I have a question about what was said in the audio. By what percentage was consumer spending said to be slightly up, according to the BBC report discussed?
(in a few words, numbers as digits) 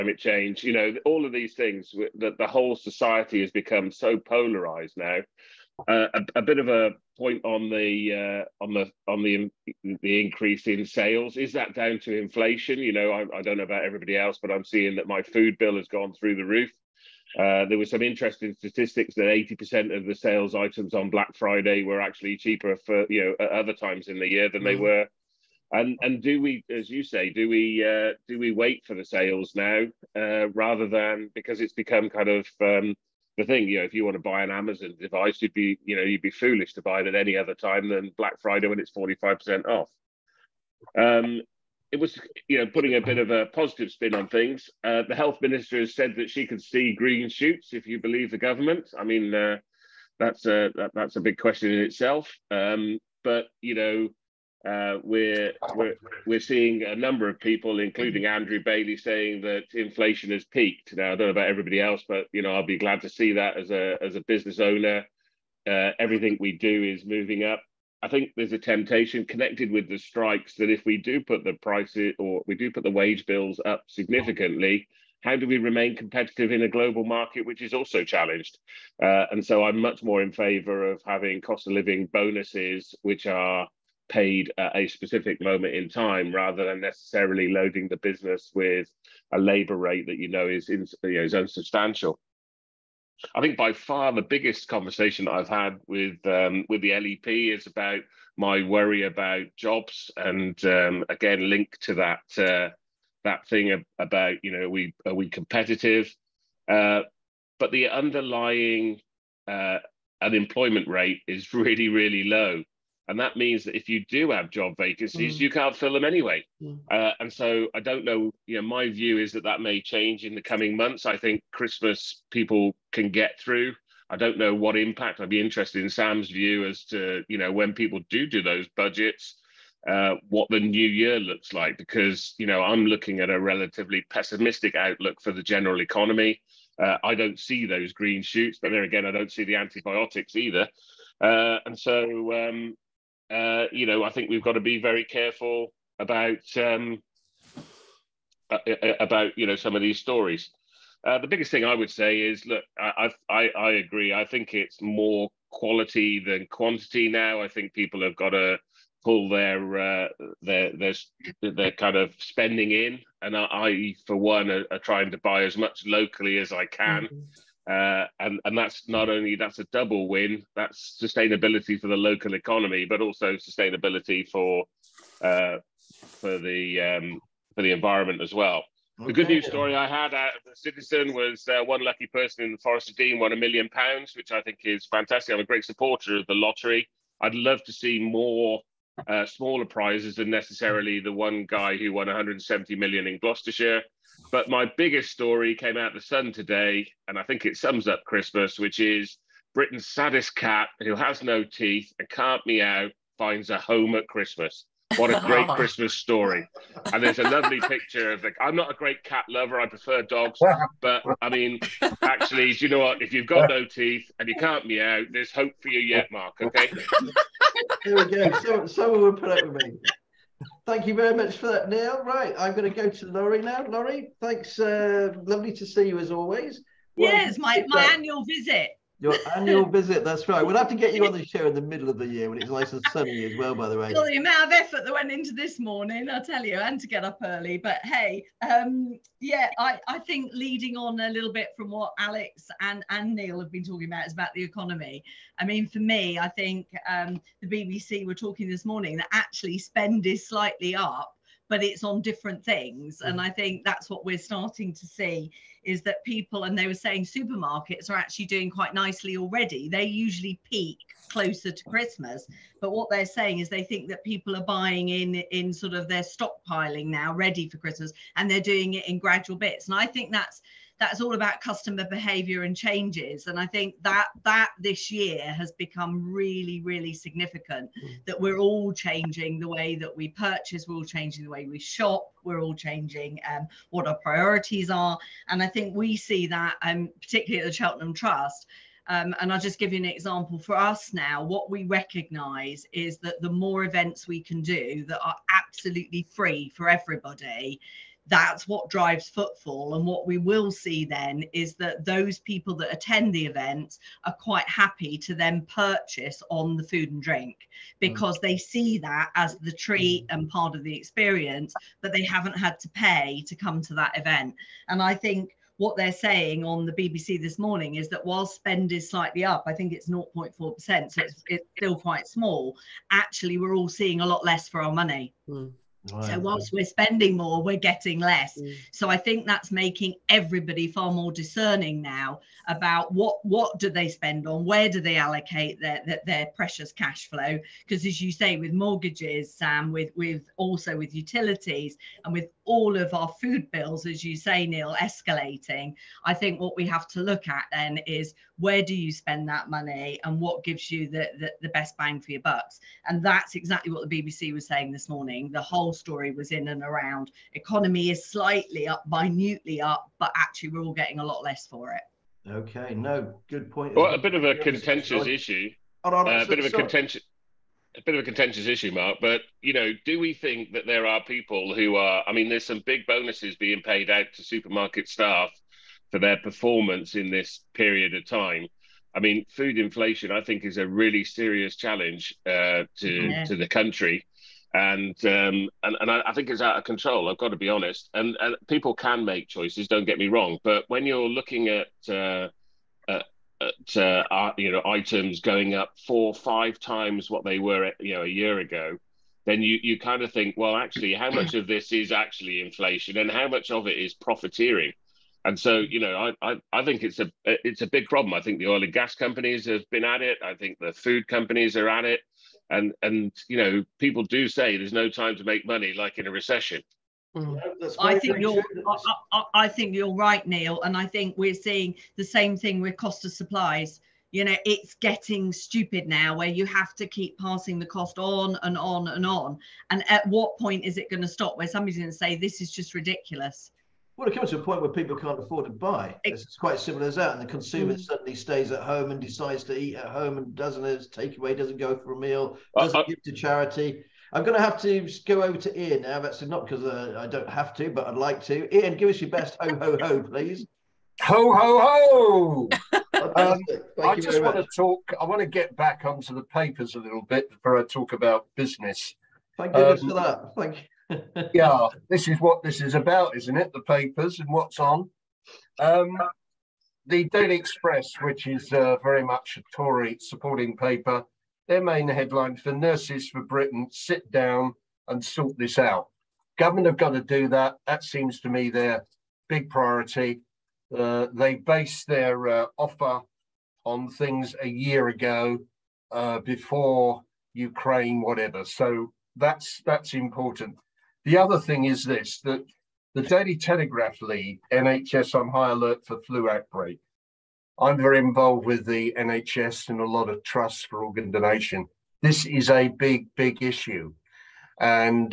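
0.4%.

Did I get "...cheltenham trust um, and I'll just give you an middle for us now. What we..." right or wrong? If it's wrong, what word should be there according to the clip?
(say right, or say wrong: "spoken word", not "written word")
wrong: "example", not "middle".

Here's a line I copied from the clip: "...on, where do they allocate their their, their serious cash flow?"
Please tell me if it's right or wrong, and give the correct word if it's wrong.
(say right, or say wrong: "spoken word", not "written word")
wrong: "precious", not "serious".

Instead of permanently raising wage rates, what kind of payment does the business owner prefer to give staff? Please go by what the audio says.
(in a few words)
Cost of living bonuses.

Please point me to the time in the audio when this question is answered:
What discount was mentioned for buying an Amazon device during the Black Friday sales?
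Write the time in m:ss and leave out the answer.
0:38.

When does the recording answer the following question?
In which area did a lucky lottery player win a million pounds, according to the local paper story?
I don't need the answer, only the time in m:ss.
3:02.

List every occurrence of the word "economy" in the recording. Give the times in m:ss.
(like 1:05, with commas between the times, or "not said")
2:15, 2:52, 4:04, 5:57.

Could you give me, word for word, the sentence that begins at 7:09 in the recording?
And at what point is it going to stop?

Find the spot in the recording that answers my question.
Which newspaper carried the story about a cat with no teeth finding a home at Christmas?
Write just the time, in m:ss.
3:15.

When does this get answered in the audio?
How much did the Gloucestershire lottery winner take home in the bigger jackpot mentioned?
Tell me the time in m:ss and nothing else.
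3:12.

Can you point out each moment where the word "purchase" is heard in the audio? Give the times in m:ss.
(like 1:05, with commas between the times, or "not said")
4:40, 5:05.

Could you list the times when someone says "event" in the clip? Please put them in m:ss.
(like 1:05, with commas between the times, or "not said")
4:53, 5:03, 5:13.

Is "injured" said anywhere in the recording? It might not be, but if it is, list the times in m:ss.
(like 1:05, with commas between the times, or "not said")
not said.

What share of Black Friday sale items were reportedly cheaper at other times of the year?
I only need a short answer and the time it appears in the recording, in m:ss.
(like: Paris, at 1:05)
80%, at 0:19.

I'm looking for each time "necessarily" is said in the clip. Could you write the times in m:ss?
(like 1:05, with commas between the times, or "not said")
1:26, 3:10.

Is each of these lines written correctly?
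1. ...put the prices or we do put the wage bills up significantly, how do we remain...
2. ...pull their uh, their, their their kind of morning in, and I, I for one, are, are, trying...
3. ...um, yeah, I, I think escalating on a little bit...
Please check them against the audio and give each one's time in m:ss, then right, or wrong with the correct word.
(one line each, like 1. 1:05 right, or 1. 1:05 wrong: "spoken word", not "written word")
1. 1:11 right
2. 2:39 wrong: "spending", not "morning"
3. 3:58 wrong: "leading", not "escalating".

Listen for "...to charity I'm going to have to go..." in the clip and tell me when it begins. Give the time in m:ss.
7:23.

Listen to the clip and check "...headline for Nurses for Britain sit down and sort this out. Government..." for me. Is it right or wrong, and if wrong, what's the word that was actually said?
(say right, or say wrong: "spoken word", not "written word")
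right.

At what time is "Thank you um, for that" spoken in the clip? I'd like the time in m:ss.
7:39.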